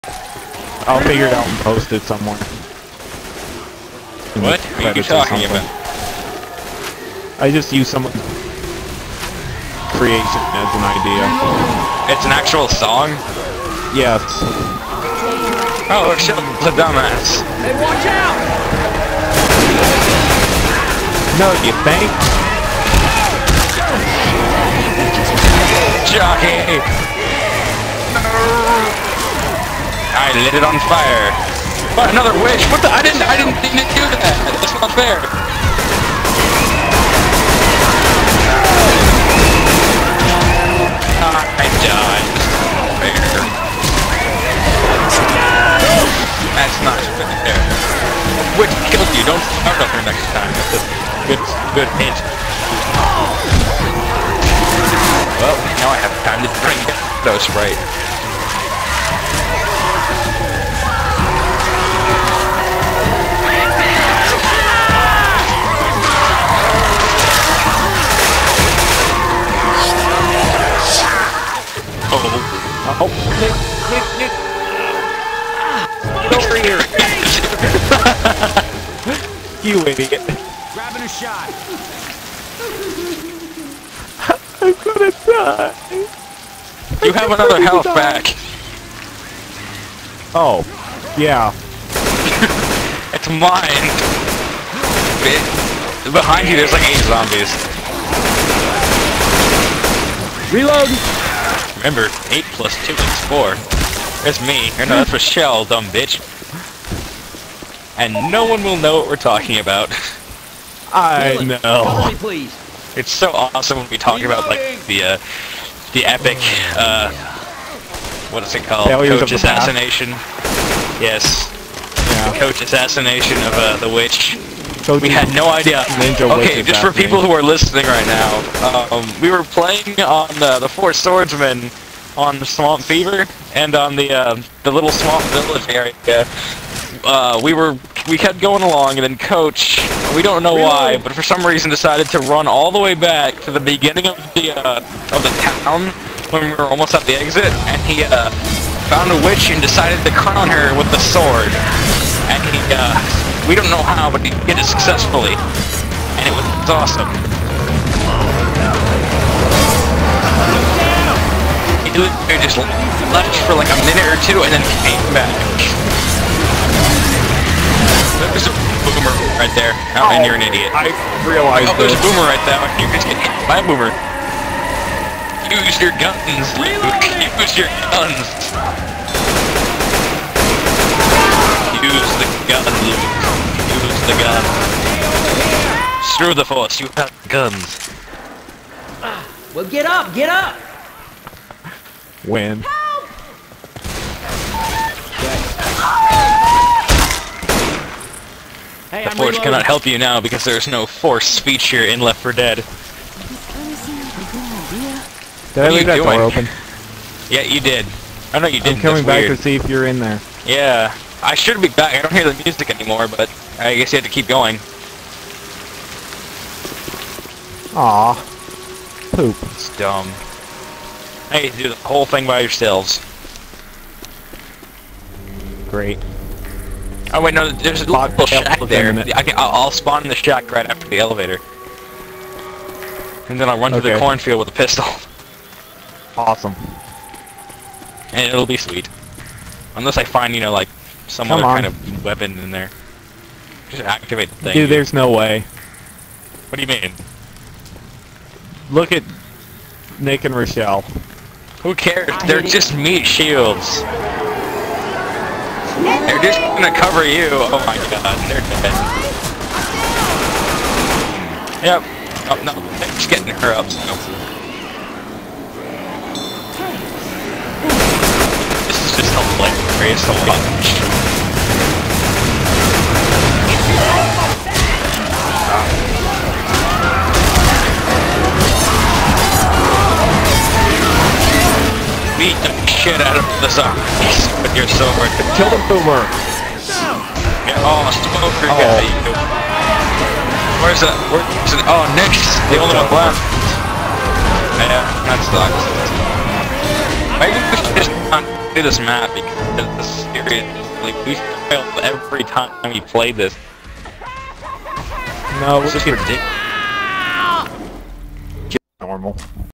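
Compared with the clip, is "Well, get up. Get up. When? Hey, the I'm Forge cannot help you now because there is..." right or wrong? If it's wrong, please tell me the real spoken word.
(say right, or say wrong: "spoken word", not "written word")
right.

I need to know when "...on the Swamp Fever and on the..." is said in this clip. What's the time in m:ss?
2:12.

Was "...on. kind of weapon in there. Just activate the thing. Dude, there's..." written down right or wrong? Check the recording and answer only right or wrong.
right.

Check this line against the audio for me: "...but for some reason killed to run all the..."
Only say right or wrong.
wrong.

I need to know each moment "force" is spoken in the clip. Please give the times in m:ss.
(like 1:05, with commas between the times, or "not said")
3:06, 3:20.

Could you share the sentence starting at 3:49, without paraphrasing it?
I can, I'll, I'll spawn in the shack right after the elevator.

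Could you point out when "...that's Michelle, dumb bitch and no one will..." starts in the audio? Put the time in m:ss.
1:44.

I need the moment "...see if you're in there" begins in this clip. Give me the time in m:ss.
3:29.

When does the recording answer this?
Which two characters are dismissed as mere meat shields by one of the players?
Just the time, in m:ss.
4:09.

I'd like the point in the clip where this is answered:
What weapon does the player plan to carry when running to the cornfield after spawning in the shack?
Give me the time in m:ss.
3:54.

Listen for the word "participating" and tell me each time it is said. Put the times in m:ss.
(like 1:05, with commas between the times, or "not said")
not said.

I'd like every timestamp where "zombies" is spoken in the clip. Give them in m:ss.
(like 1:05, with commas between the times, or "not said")
1:37, 4:43.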